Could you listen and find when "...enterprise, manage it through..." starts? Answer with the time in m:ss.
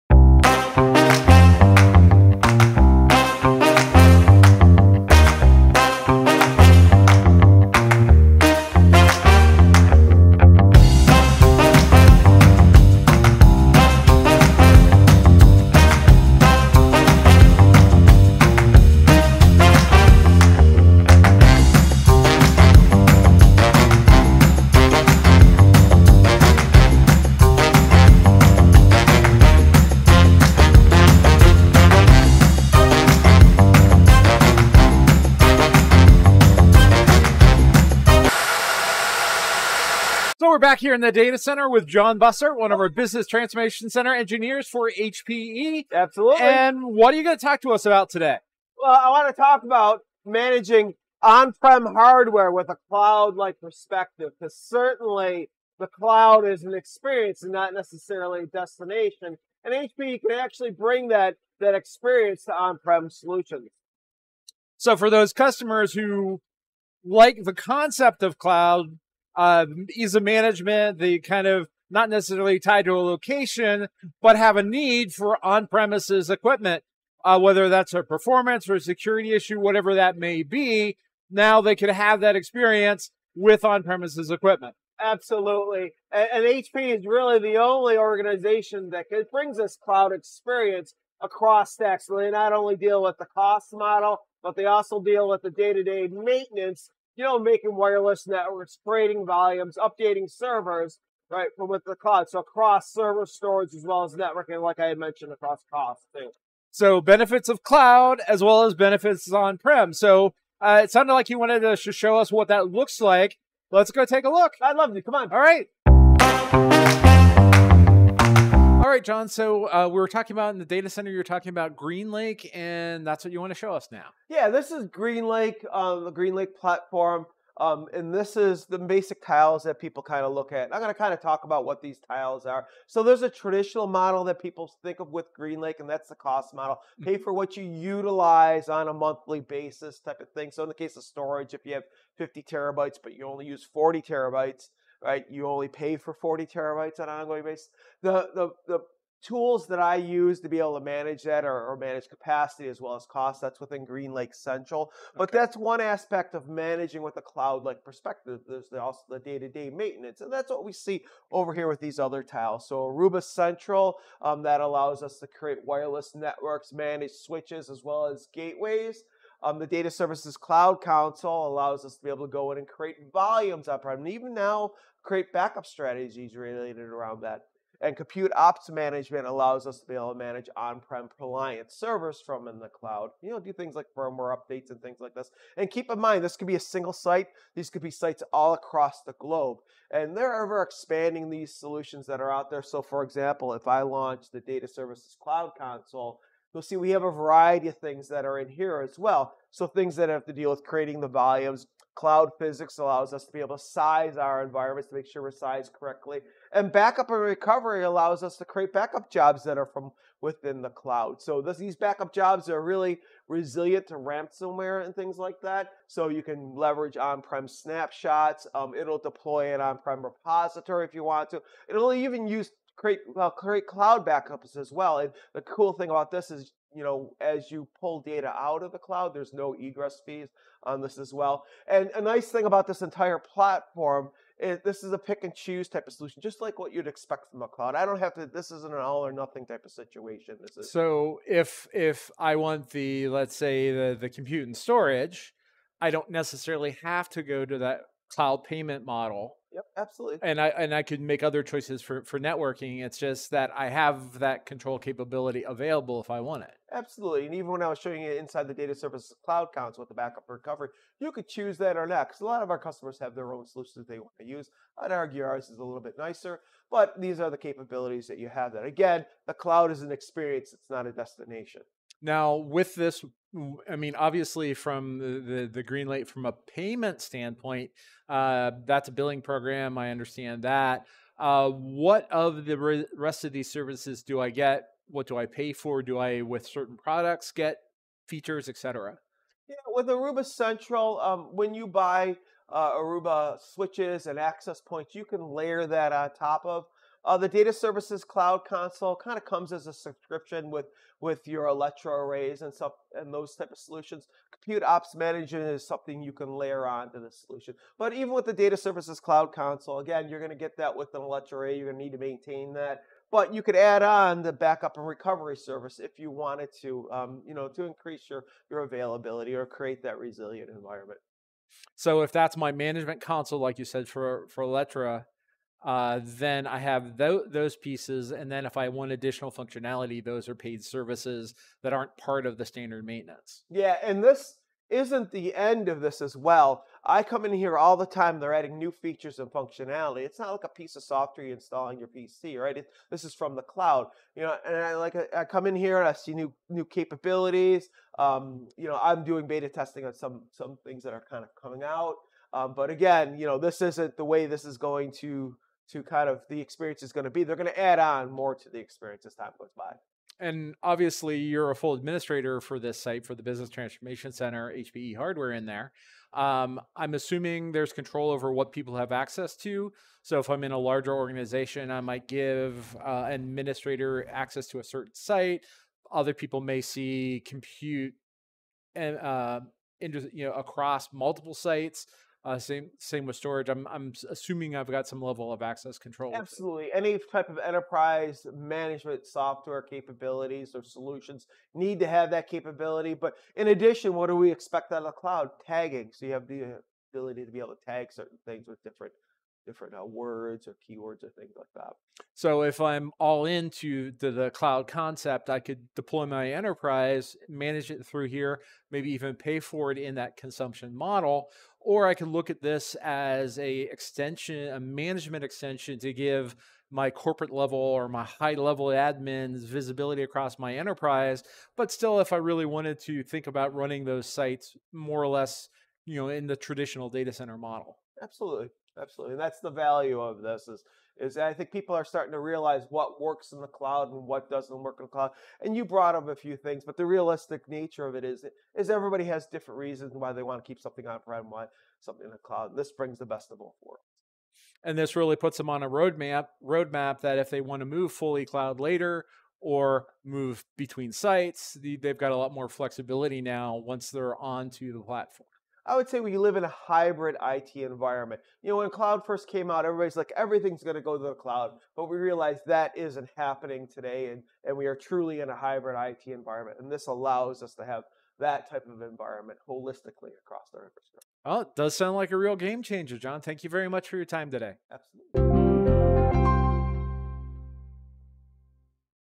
6:46.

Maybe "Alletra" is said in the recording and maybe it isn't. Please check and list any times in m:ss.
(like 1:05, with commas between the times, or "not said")
5:01, 5:11, 5:24.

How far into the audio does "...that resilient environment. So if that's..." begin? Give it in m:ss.
5:19.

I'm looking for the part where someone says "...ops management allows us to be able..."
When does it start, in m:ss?
2:58.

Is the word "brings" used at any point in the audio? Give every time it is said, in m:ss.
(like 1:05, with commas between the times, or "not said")
1:00, 1:29, 7:22.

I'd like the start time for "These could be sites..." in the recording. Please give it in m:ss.
3:07.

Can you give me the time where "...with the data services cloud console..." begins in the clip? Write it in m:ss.
5:08.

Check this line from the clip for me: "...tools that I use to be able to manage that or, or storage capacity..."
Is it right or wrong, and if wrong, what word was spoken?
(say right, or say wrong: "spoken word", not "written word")
wrong: "manage", not "storage".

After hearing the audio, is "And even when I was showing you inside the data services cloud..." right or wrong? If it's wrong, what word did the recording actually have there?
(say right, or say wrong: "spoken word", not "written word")
right.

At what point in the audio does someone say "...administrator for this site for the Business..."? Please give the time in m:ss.
6:01.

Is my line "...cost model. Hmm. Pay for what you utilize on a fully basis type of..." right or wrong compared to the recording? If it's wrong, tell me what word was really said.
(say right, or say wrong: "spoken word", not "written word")
wrong: "monthly", not "fully".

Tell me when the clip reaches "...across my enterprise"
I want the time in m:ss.
7:00.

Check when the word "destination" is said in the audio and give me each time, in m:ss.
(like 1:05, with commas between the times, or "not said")
0:58, 4:30.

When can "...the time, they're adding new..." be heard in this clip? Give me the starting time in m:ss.
5:37.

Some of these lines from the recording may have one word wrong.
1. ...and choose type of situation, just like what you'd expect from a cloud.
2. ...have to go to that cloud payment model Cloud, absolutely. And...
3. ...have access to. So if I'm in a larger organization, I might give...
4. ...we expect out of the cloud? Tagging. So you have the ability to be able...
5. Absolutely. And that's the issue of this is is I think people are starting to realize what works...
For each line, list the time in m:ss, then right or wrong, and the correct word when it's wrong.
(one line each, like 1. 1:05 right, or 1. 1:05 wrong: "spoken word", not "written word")
1. 3:55 wrong: "solution", not "situation"
2. 4:06 wrong: "Yep", not "Cloud"
3. 6:08 right
4. 6:34 right
5. 7:08 wrong: "value", not "issue".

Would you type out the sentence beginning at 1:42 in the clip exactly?
So across server storage as well as networking, like I had mentioned, across cost.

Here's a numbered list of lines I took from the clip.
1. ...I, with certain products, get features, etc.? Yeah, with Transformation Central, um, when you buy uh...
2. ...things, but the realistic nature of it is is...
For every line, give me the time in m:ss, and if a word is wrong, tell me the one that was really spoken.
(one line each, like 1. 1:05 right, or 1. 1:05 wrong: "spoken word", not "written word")
1. 4:45 wrong: "Aruba", not "Transformation"
2. 7:16 right.